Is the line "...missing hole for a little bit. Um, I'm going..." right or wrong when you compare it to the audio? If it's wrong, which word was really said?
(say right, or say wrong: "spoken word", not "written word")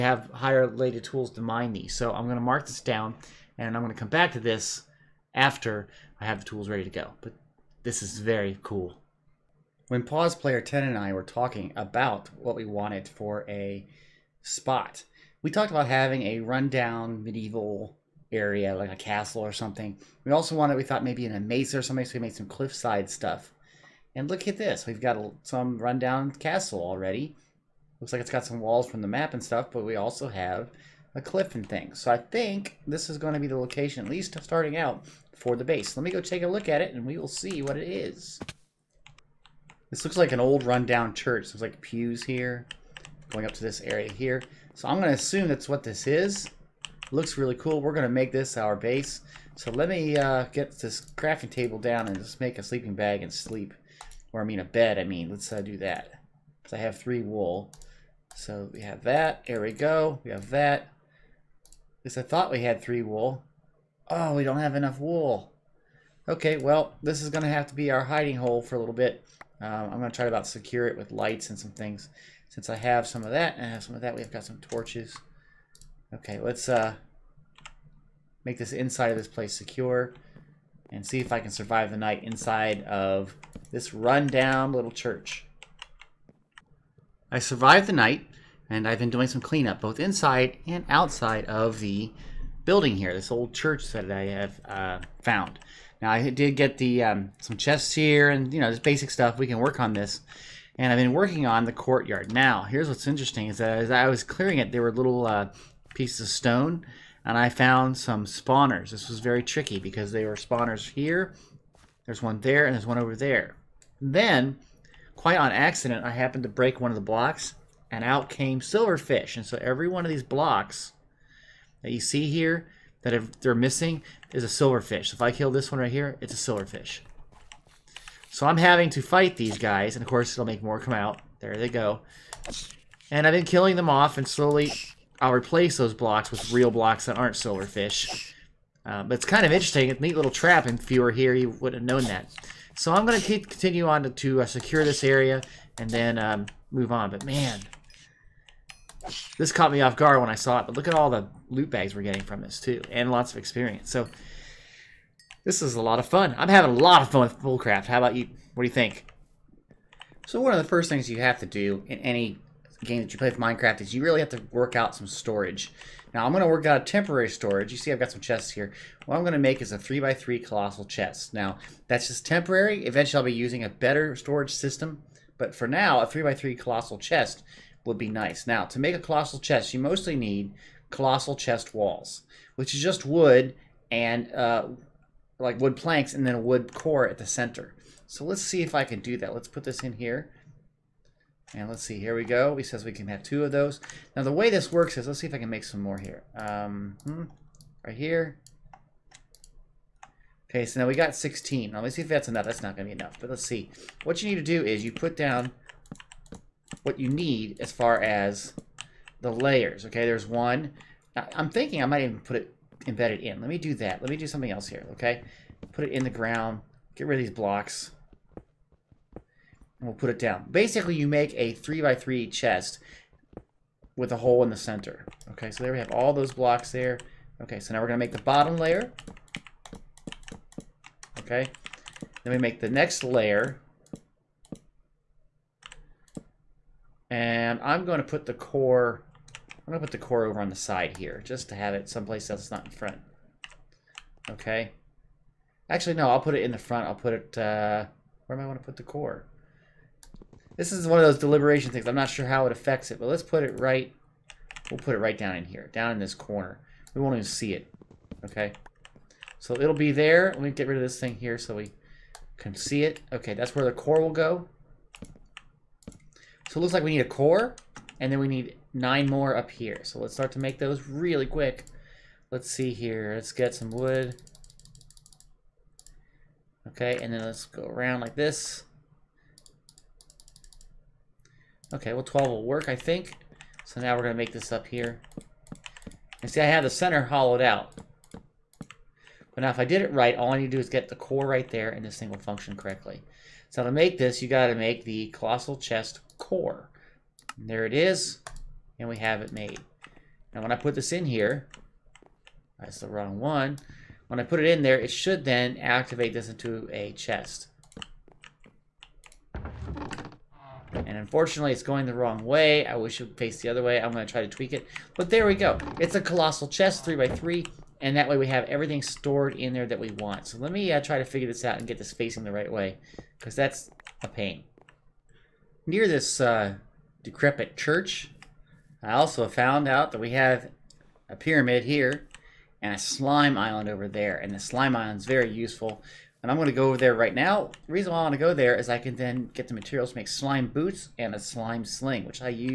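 wrong: "hiding", not "missing".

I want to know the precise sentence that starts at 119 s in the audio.
And so every one of these blocks that you see here that if they're missing is a silverfish.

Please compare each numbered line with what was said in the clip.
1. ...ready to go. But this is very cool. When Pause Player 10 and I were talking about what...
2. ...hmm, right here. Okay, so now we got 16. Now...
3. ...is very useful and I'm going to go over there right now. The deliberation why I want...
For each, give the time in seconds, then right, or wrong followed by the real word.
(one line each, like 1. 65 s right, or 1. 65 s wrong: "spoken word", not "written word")
1. 6 s right
2. 197 s right
3. 334 s wrong: "reason", not "deliberation".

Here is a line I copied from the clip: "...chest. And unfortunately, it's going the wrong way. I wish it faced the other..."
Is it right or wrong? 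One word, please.
right.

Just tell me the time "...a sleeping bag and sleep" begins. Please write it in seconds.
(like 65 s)
52 s.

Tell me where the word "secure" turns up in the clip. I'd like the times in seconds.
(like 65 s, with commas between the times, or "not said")
70 s, 79 s, 144 s.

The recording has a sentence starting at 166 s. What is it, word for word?
Now I'm going to work out a temporary storage.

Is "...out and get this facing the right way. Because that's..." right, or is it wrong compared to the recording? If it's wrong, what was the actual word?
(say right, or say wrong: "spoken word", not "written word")
right.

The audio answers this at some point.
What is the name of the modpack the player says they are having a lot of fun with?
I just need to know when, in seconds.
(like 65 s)
157 s.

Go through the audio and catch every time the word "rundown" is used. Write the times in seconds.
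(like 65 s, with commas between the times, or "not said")
16 s, 25 s, 40 s, 83 s.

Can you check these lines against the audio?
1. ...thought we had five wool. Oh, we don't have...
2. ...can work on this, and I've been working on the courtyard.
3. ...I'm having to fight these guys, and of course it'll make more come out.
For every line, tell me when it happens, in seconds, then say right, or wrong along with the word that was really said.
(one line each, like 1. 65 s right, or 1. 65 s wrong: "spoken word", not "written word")
1. 62 s wrong: "three", not "five"
2. 99 s right
3. 128 s right.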